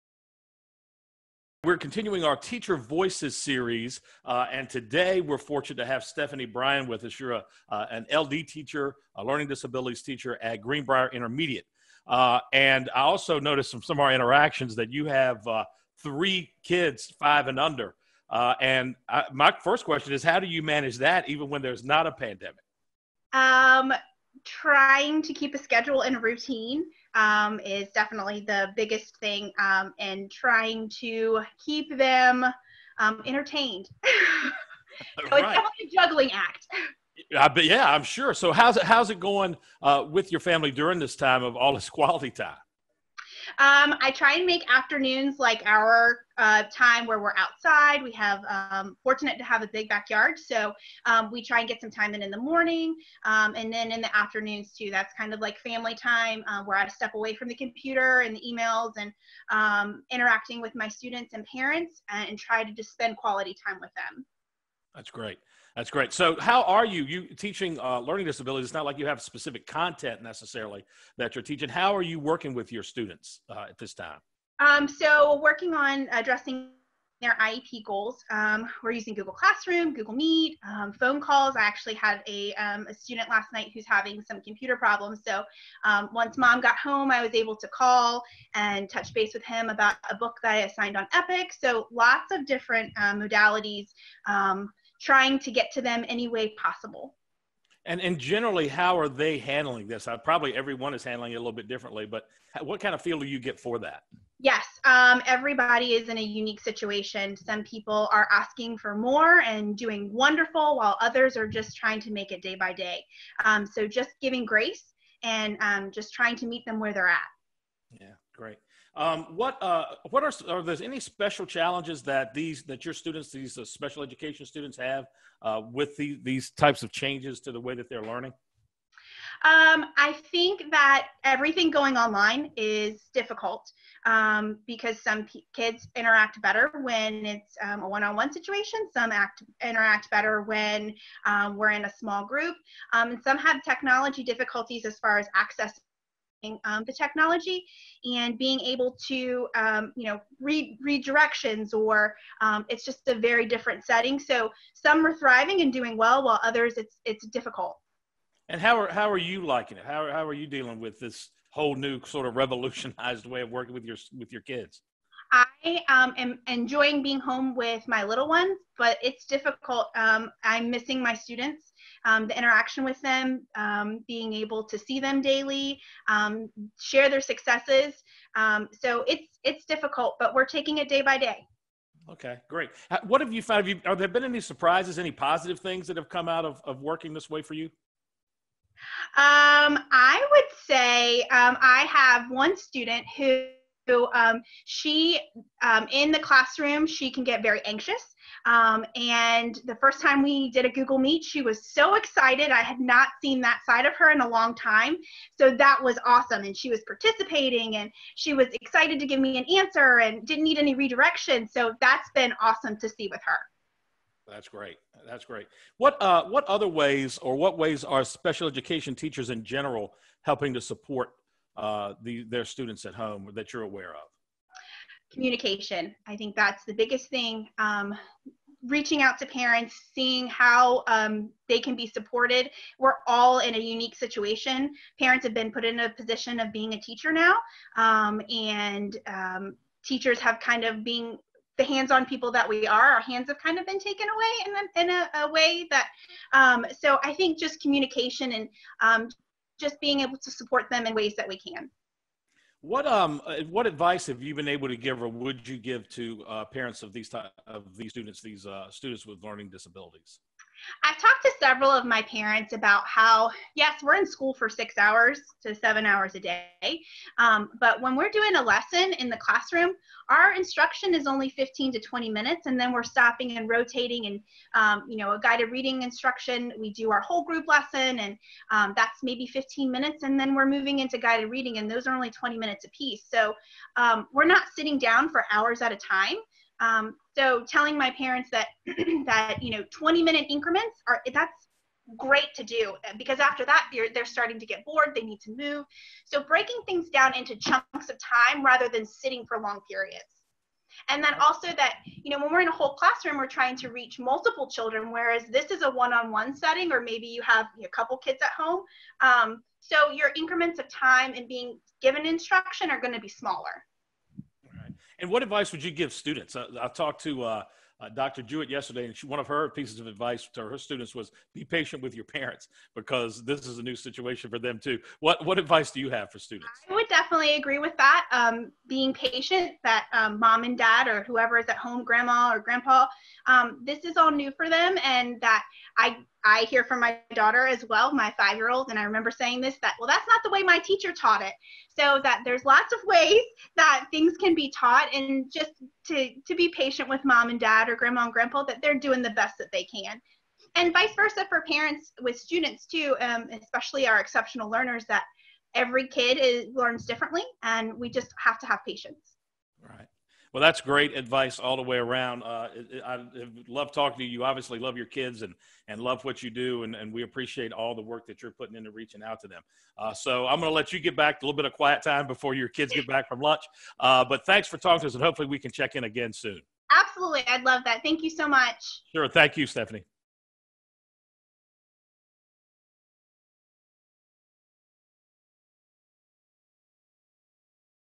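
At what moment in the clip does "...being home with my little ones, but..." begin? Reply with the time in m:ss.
2:47.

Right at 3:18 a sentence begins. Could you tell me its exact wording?
Um, and the first time we did a Google Meet, she was so excited.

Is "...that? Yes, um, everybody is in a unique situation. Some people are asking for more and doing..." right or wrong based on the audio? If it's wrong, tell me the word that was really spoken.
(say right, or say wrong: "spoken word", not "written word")
right.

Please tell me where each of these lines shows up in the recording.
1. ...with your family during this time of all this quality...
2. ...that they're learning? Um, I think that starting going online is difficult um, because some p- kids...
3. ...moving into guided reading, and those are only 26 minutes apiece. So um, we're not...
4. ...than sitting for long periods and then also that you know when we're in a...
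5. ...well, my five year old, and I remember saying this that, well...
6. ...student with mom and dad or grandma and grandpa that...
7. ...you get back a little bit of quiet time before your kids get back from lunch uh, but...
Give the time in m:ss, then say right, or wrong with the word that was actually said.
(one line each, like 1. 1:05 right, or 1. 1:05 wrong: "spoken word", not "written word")
1. 0:40 right
2. 2:07 wrong: "everything", not "starting"
3. 4:40 wrong: "20", not "26"
4. 4:58 right
5. 5:37 right
6. 5:46 wrong: "patient", not "student"
7. 6:10 right.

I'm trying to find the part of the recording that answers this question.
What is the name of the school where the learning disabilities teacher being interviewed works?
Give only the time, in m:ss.
0:10.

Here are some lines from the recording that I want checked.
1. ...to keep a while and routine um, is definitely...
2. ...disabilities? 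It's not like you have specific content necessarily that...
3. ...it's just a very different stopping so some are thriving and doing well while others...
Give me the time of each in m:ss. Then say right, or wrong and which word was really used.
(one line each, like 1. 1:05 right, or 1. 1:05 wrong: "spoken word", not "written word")
1. 0:25 wrong: "schedule", not "while"
2. 1:08 right
3. 2:32 wrong: "setting", not "stopping".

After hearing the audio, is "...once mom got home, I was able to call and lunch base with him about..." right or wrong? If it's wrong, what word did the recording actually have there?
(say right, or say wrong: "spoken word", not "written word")
wrong: "touch", not "lunch".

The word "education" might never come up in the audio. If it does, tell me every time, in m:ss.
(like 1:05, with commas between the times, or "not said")
2:04, 3:38.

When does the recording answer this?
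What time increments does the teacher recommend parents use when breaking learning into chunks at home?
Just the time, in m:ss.
4:49.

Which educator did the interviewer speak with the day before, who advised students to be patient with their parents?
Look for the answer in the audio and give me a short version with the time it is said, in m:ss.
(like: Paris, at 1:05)
Dr. Jewett, at 5:17.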